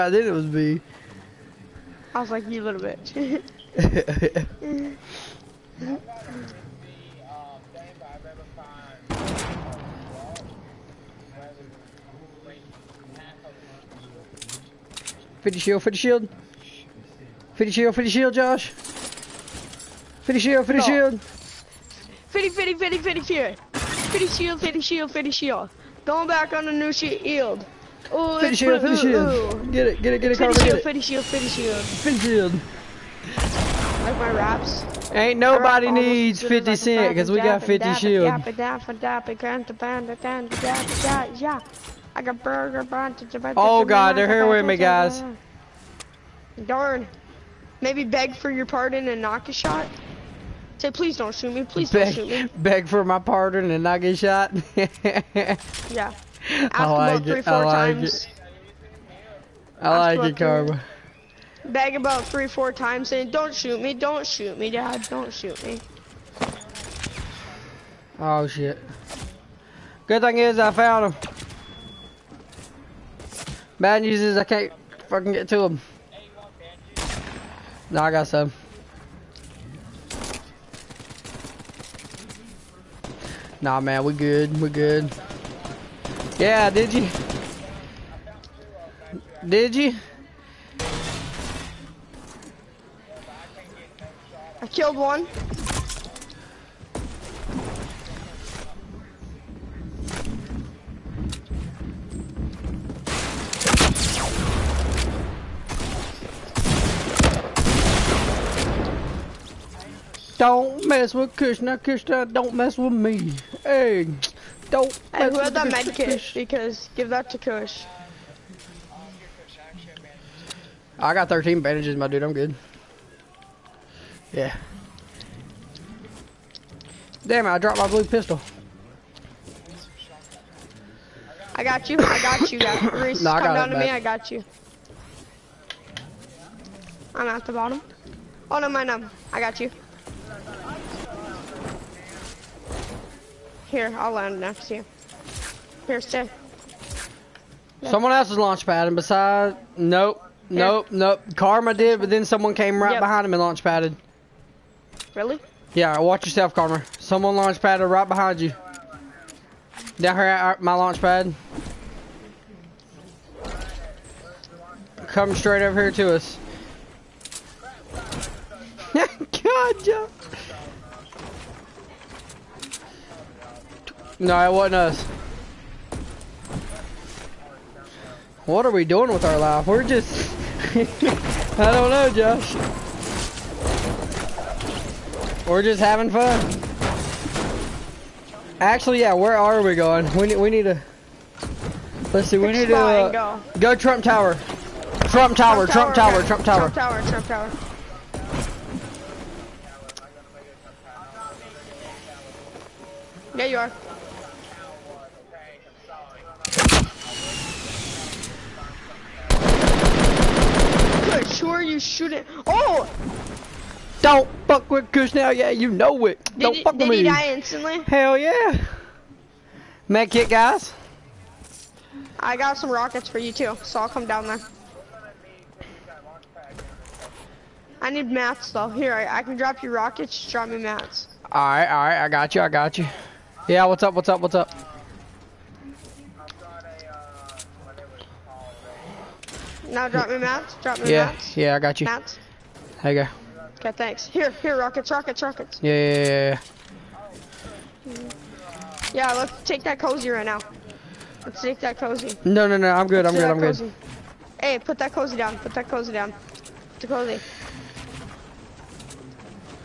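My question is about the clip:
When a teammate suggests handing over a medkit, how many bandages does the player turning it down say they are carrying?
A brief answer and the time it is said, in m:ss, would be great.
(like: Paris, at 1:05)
13, at 2:01.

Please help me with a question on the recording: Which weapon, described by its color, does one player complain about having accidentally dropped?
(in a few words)
Blue pistol.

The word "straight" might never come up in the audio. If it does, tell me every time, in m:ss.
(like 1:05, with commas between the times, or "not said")
2:45.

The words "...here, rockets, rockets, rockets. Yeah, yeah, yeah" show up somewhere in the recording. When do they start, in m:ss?
4:04.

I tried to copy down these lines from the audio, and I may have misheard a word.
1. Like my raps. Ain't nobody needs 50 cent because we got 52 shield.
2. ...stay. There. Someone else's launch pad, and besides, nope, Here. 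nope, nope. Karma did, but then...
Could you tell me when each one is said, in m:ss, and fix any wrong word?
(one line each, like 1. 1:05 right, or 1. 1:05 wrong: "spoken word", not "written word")
1. 0:34 wrong: "50", not "52"
2. 2:26 right.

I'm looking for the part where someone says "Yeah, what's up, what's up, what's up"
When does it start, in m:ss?
3:53.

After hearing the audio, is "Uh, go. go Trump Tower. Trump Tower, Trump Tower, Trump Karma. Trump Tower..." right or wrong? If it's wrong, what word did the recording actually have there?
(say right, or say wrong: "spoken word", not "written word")
wrong: "Tower", not "Karma".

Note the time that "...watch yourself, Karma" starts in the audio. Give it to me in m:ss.
2:35.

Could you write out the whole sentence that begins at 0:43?
Oh god, they're here with me guys.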